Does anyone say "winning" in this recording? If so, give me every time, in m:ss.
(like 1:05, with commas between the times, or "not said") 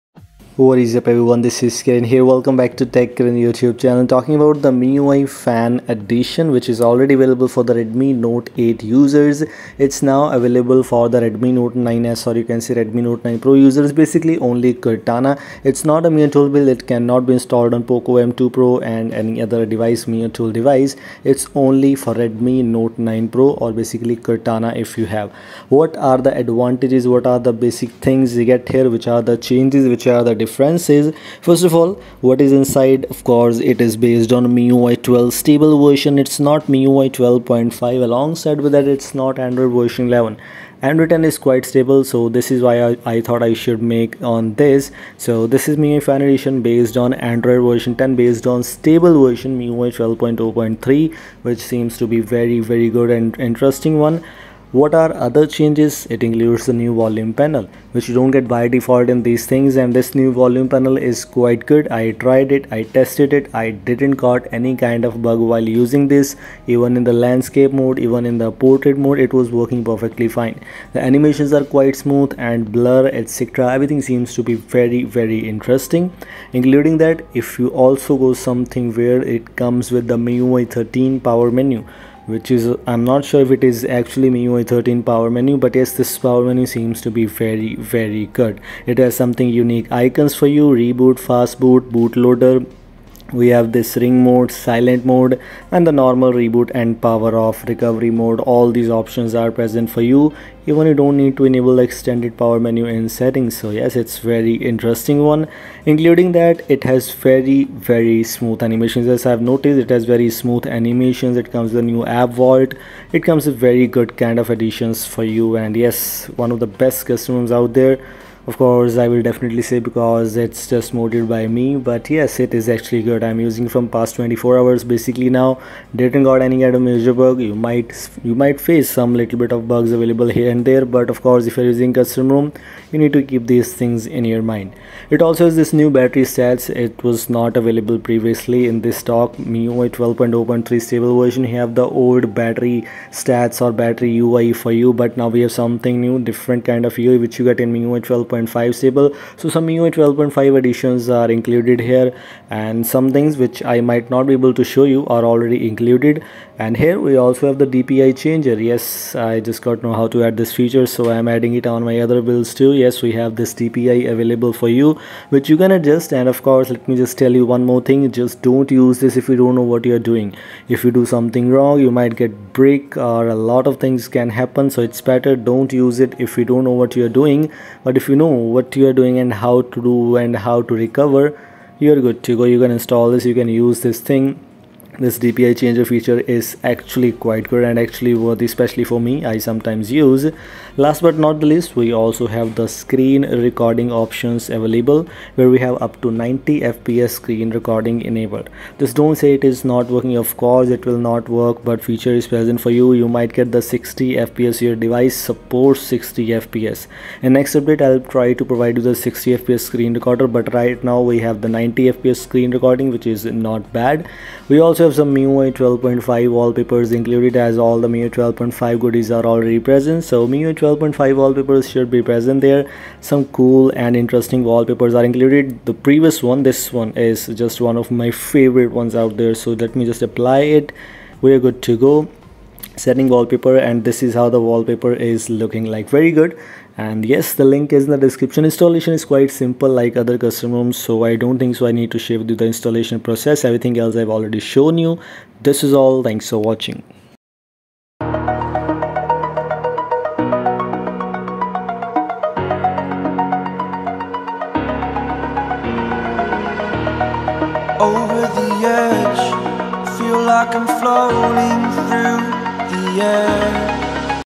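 not said.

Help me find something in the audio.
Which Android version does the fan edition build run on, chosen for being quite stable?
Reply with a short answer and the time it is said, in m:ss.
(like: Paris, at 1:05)
Android 10, at 0:47.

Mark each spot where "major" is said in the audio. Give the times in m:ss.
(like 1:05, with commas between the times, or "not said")
2:06.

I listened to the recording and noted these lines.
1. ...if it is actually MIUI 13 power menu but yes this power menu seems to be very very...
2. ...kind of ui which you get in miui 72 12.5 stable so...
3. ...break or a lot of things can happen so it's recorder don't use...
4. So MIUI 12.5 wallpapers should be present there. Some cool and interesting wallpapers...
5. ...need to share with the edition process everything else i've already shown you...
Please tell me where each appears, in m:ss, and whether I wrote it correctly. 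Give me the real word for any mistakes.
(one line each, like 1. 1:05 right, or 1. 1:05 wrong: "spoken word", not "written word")
1. 1:23 right
2. 2:26 wrong: "12", not "72"
3. 2:52 wrong: "better", not "recorder"
4. 3:40 right
5. 4:01 wrong: "installation", not "edition".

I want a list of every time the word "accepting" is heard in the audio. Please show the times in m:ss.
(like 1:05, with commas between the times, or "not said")
not said.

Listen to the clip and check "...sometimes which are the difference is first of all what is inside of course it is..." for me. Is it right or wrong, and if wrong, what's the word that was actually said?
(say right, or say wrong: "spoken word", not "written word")
wrong: "changes", not "sometimes".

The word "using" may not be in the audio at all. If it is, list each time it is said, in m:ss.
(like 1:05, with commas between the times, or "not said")
1:05, 2:03, 2:11.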